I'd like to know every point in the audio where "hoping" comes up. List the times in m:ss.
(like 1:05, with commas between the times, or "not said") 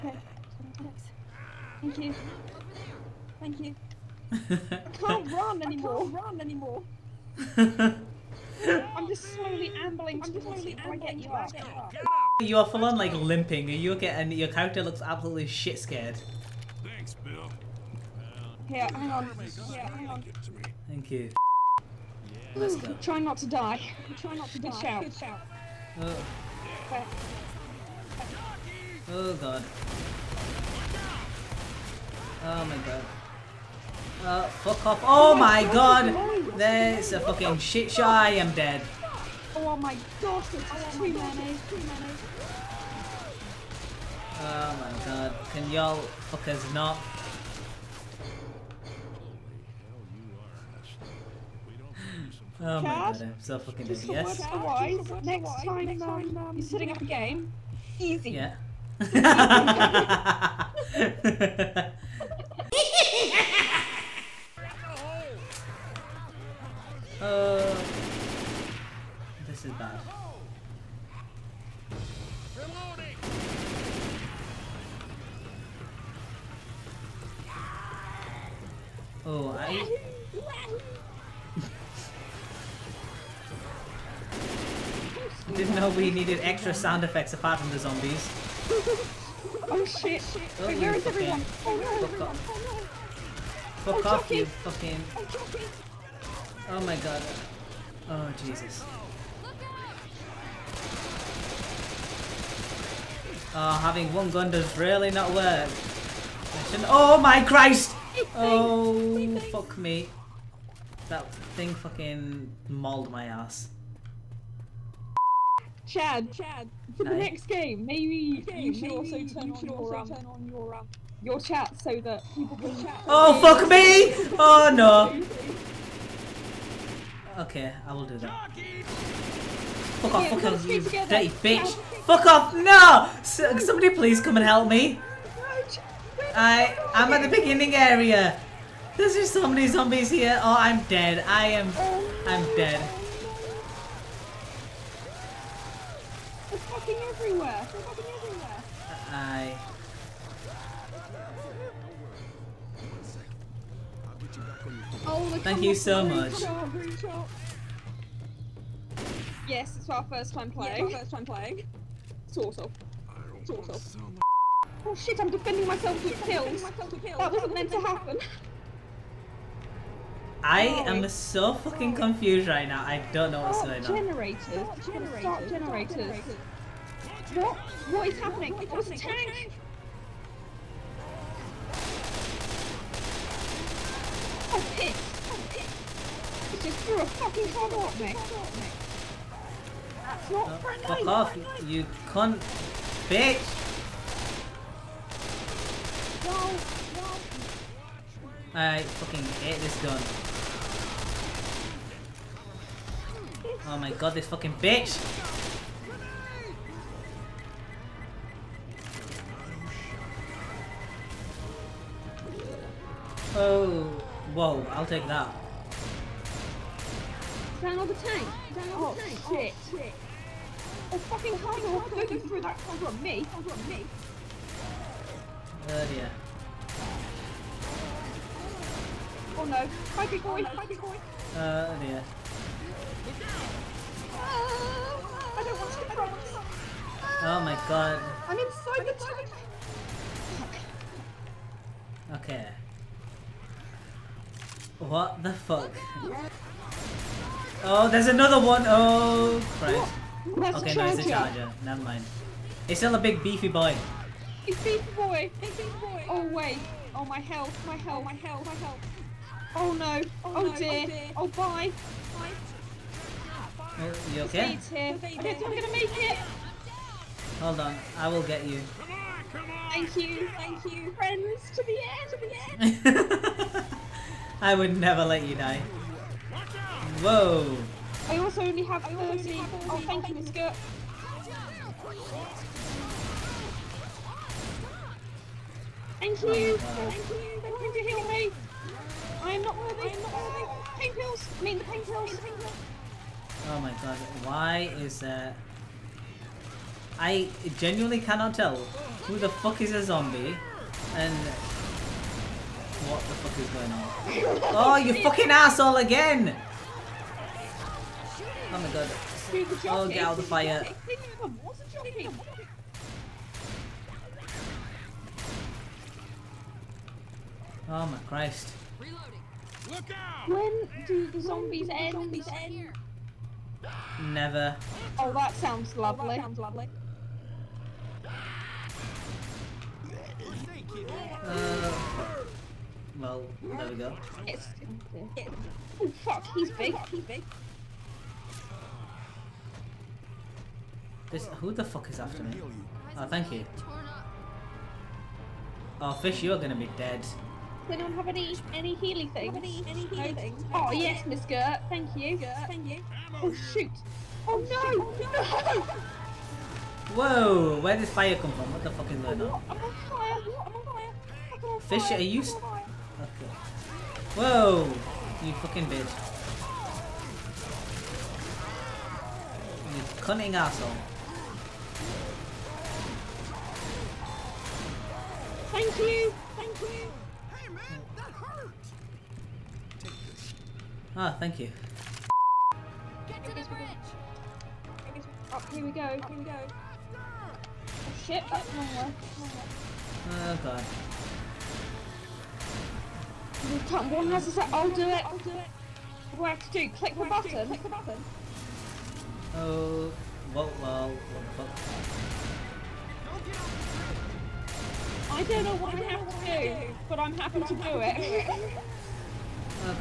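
not said.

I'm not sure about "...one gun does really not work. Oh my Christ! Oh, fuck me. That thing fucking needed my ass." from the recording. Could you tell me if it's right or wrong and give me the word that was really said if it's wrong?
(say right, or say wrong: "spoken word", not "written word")
wrong: "mauled", not "needed".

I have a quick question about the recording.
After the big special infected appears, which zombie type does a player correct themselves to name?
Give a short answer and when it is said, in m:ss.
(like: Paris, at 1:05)
Charger, at 4:10.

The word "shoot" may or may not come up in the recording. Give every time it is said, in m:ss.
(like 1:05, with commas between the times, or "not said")
5:53.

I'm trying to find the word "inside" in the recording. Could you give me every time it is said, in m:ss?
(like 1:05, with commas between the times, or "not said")
3:58.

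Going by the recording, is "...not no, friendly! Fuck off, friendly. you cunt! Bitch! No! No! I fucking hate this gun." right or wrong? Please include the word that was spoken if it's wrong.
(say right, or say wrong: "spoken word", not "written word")
right.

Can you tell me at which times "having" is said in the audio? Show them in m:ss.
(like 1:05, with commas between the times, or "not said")
1:43.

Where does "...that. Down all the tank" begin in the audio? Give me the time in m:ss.
3:35.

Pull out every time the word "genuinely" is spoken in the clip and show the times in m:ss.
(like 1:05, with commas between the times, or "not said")
4:57.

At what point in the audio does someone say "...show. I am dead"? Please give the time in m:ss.
0:37.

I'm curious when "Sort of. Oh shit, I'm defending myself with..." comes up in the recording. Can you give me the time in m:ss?
2:43.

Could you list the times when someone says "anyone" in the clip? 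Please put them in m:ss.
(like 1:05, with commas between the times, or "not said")
5:47.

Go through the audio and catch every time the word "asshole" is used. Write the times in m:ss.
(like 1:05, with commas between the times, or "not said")
5:05, 6:10.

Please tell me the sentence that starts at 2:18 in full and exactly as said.
There's just so many zombies here.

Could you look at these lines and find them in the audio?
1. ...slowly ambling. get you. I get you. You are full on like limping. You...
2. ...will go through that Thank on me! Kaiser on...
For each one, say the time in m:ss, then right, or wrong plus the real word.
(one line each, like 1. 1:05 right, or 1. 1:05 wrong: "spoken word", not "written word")
1. 0:10 right
2. 3:41 wrong: "Kaiser", not "Thank".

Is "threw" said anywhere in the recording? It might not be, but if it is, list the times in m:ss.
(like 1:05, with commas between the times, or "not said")
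3:06.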